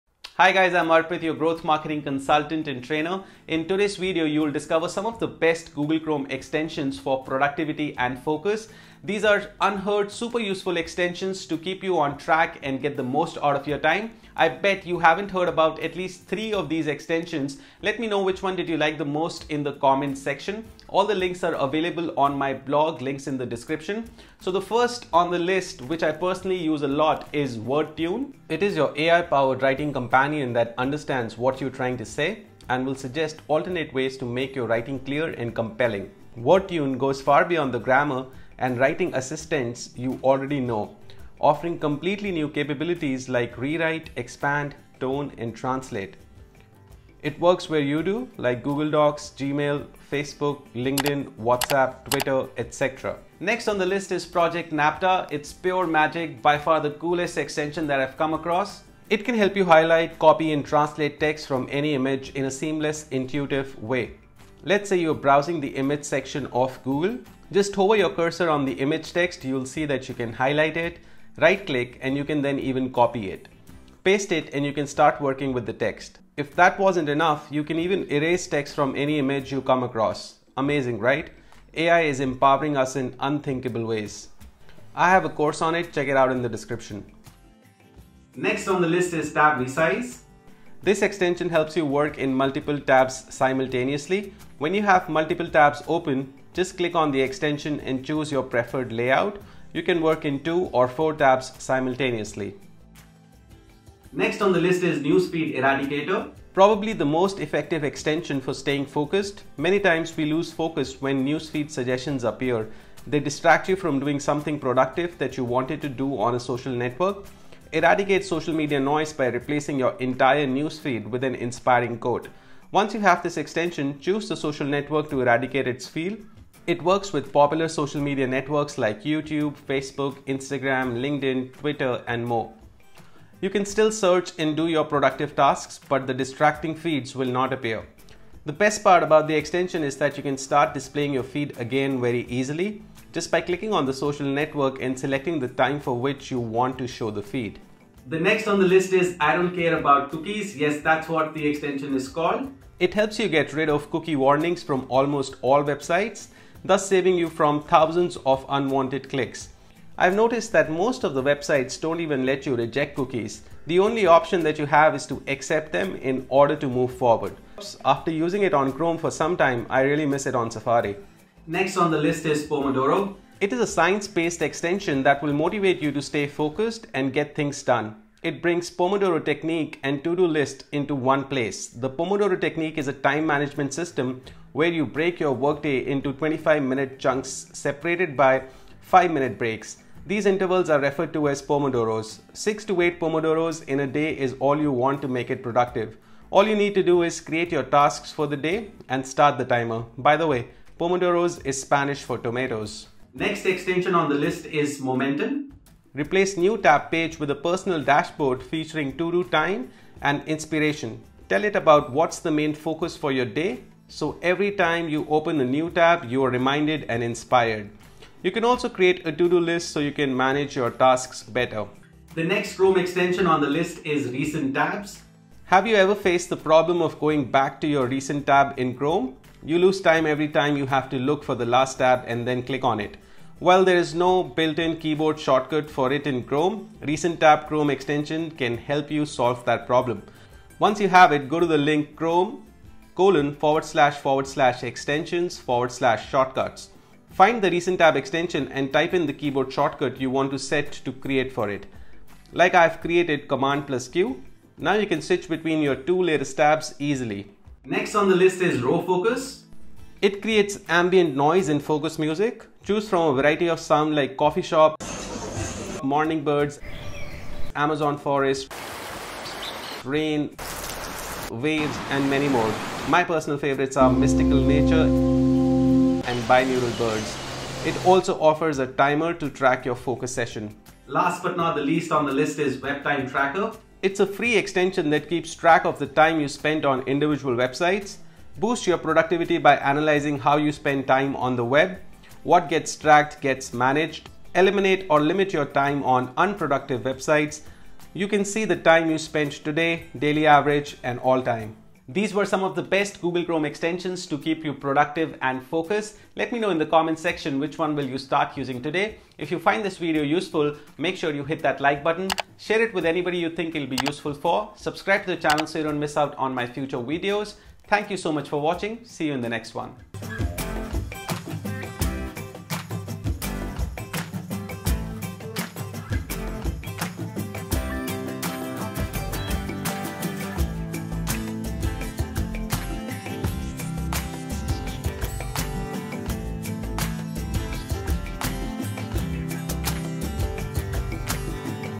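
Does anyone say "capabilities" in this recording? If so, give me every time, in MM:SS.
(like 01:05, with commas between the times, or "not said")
00:42.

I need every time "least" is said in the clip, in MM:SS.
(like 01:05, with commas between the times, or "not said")
00:15, 04:41.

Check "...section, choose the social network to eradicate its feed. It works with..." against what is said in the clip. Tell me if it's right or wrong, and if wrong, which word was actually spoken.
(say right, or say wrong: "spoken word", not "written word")
wrong: "extension", not "section".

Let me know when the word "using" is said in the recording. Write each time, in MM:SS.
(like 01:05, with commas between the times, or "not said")
02:48, 05:08.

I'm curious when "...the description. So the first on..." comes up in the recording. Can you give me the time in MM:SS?
00:23.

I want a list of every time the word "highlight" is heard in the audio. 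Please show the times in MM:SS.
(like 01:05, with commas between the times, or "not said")
00:59, 01:10.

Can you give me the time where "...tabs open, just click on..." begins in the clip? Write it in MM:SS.
01:35.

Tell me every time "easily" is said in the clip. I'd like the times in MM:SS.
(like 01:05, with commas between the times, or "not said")
02:22, 04:16.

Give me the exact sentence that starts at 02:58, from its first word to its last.
It brings Pomodoro technique and to-do list into one place.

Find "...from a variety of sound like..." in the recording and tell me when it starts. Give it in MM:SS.
04:22.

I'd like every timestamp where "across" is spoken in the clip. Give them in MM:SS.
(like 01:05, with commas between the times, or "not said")
00:58, 01:19.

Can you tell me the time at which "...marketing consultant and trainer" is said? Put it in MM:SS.
00:01.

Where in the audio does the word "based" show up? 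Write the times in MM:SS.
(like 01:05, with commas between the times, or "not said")
02:53.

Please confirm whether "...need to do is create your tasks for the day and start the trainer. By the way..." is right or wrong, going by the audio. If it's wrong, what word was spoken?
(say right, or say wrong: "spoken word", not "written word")
wrong: "timer", not "trainer".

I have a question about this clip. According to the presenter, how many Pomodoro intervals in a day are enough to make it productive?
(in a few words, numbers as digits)
6 to 8.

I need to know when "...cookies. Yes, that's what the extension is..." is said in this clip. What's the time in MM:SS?
02:30.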